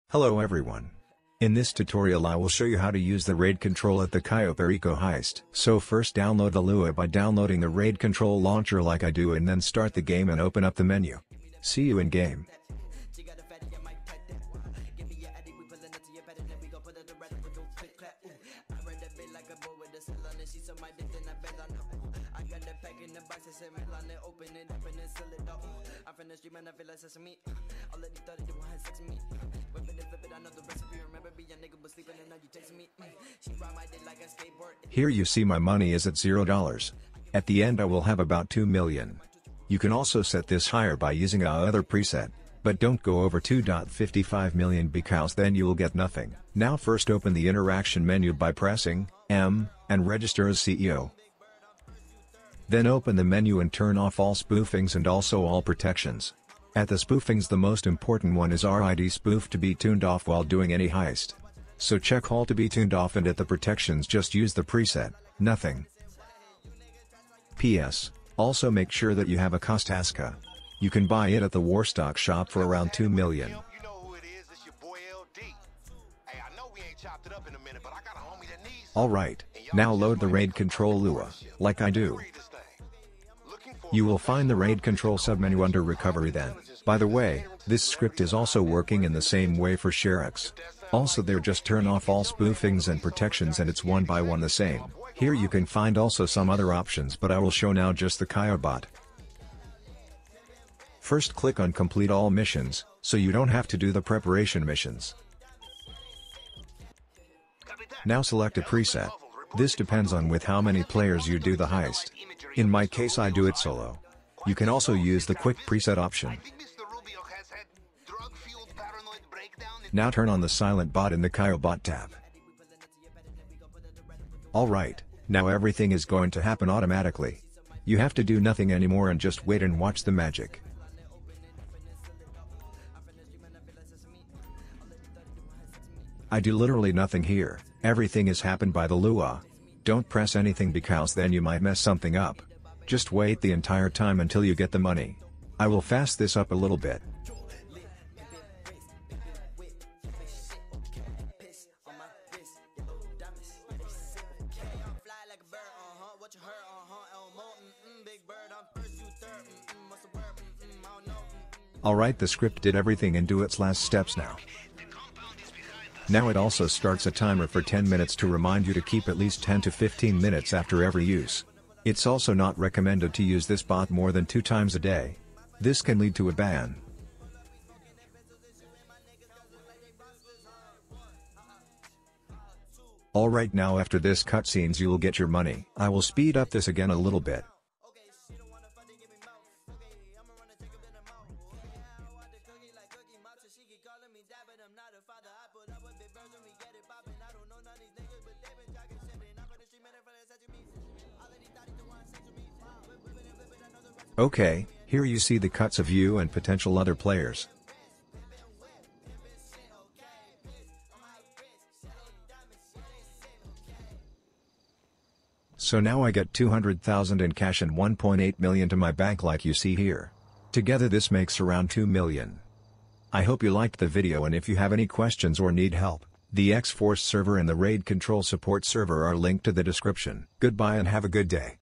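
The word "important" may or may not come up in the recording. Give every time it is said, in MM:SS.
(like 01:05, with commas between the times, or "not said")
00:57.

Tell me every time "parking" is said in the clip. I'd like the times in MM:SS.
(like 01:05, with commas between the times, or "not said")
not said.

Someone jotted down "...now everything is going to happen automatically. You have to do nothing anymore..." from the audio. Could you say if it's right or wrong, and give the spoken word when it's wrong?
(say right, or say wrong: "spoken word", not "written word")
right.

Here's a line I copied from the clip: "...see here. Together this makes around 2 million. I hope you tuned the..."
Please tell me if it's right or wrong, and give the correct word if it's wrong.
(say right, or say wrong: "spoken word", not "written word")
wrong: "liked", not "tuned".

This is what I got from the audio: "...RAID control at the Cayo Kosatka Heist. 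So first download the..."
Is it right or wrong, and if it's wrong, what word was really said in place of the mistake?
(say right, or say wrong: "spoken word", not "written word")
wrong: "Perico", not "Kosatka".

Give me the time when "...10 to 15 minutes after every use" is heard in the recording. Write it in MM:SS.
02:49.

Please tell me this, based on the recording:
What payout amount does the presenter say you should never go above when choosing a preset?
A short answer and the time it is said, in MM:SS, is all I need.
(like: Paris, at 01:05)
2.55 million, at 00:43.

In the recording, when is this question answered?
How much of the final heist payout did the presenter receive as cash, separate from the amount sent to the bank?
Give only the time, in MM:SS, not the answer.
03:36.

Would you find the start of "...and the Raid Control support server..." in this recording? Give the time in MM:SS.
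03:47.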